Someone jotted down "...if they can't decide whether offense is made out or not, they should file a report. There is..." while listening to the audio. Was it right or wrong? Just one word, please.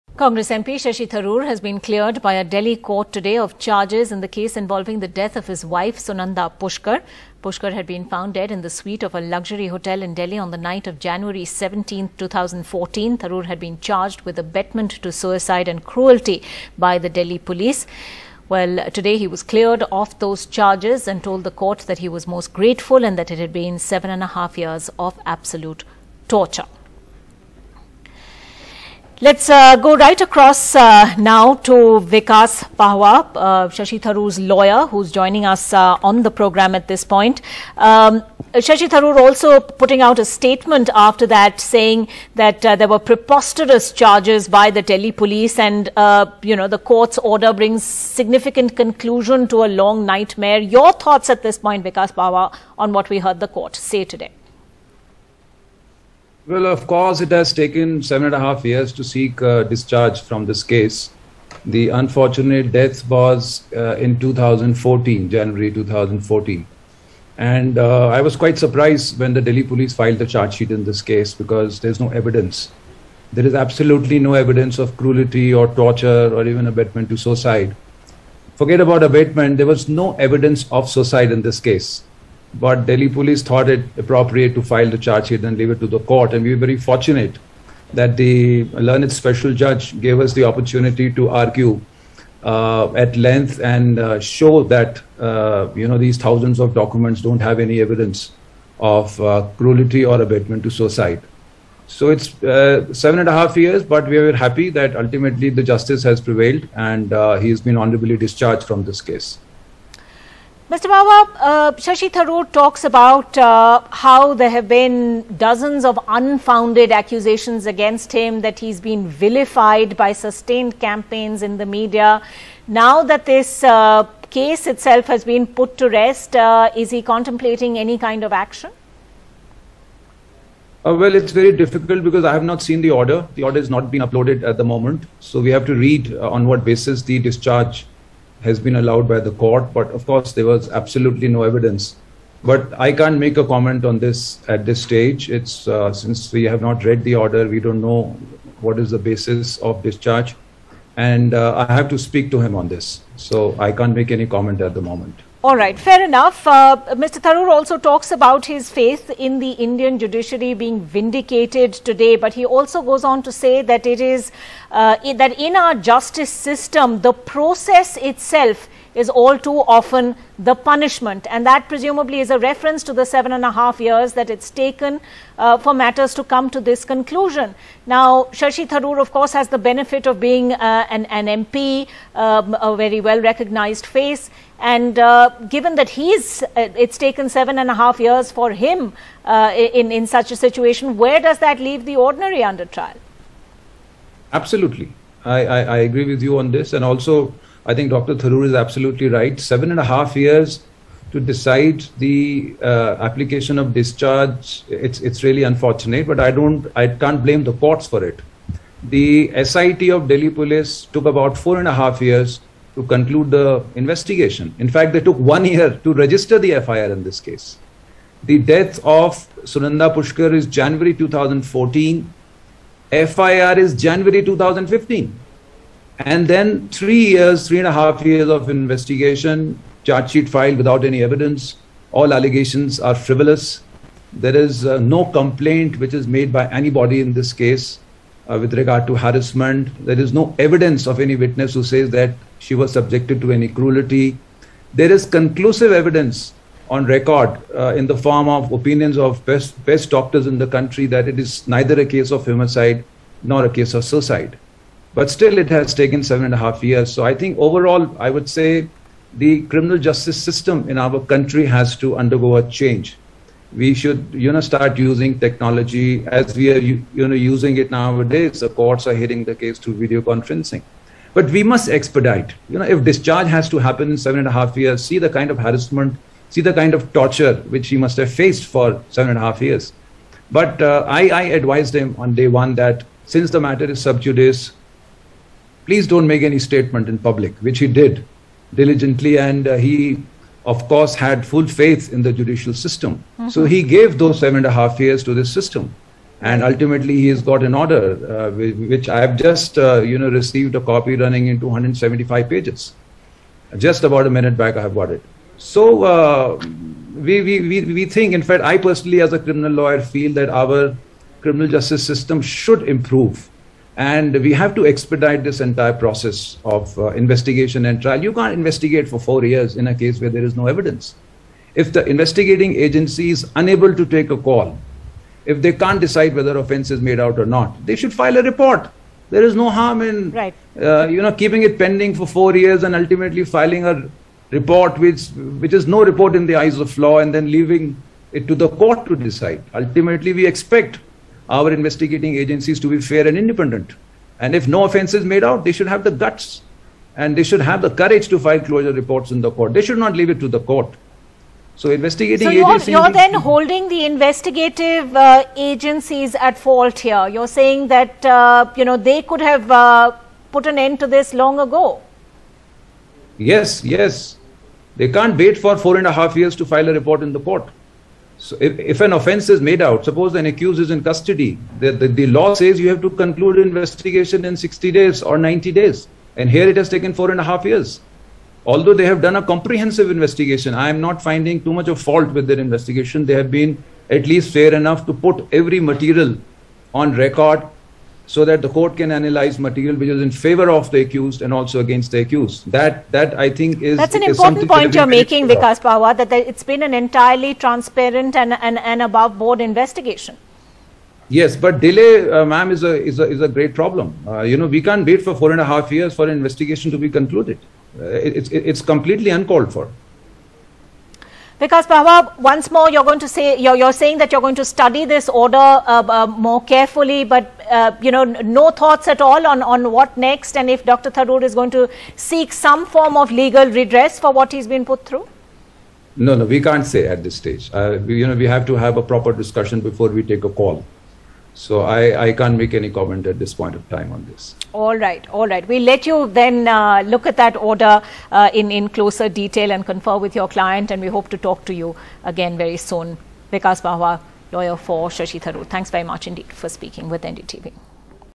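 right.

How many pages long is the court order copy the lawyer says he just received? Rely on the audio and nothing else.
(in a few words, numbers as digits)
275.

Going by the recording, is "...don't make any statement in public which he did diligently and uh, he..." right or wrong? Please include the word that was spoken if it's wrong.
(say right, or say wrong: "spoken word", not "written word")
right.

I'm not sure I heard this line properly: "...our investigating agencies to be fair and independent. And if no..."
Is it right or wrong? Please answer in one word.
right.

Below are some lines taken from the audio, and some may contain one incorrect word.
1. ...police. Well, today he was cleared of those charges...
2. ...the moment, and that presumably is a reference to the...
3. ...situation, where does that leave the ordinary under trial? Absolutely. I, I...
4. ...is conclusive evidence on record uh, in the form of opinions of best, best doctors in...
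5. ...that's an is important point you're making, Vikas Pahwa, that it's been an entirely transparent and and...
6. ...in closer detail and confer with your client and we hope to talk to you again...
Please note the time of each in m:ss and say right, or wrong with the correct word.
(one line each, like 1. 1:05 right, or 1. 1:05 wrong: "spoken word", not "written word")
1. 0:17 right
2. 2:50 wrong: "punishment", not "moment"
3. 3:10 right
4. 4:04 right
5. 6:33 right
6. 7:18 right.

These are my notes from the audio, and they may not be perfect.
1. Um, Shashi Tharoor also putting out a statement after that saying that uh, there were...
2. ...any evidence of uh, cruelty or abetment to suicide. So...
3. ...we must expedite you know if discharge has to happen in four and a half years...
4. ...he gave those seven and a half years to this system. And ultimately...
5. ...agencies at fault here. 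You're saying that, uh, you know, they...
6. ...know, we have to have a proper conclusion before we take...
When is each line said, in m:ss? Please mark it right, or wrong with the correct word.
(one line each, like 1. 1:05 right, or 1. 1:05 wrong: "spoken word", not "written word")
1. 0:37 right
2. 1:37 right
3. 4:31 wrong: "seven", not "four"
4. 4:53 right
5. 5:55 right
6. 7:08 wrong: "discussion", not "conclusion".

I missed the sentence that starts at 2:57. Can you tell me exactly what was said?
Now, Shashi Tharoor, of course, has the benefit of being uh, an, an MP, um, a very well well recognized face.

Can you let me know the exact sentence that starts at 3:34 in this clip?
In fact, they took one year to register the FIR in this case.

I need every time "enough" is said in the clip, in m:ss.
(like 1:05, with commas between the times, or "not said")
2:36, 6:24.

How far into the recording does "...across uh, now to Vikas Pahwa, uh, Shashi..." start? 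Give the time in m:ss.
0:30.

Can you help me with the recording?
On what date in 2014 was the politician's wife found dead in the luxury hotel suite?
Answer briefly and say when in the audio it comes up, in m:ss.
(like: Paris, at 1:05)
January 17, at 0:10.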